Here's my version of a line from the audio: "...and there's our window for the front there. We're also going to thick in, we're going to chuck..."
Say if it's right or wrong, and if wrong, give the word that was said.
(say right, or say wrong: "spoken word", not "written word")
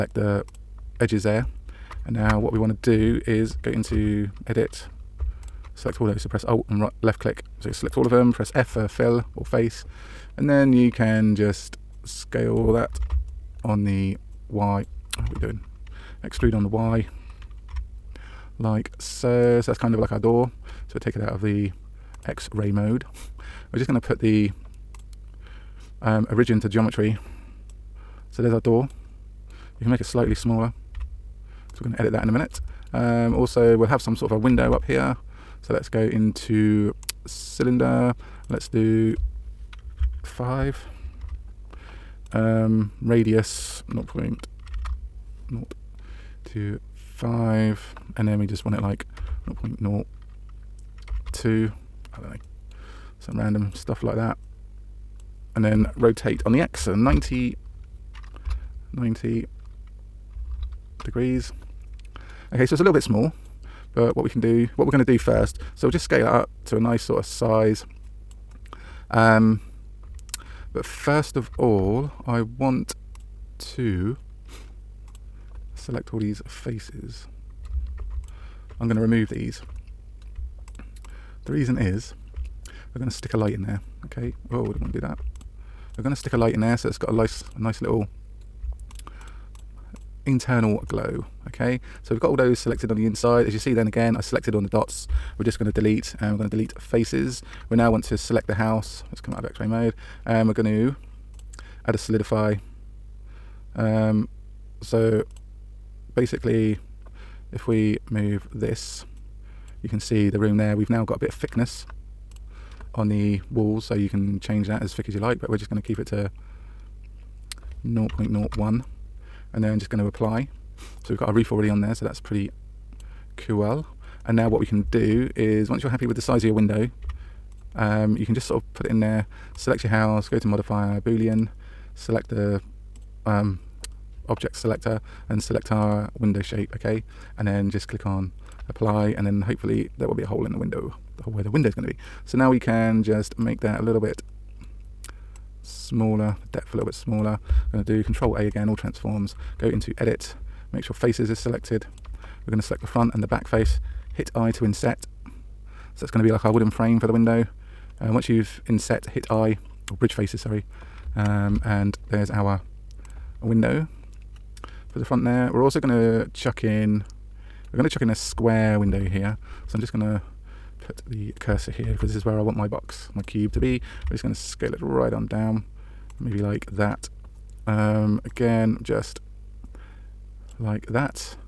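wrong: "chuck", not "thick".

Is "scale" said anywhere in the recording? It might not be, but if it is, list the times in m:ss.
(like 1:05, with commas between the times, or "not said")
0:12, 1:06, 2:54.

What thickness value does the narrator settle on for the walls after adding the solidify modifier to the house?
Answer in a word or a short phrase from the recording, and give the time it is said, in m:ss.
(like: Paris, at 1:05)
0.01, at 1:57.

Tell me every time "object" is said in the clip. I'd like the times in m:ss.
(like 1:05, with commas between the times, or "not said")
2:14.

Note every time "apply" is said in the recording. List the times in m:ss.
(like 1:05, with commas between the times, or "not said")
2:00, 2:18.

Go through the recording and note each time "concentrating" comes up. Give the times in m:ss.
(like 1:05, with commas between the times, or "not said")
not said.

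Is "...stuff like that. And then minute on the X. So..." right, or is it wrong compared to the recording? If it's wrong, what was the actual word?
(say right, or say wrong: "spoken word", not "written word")
wrong: "rotate", not "minute".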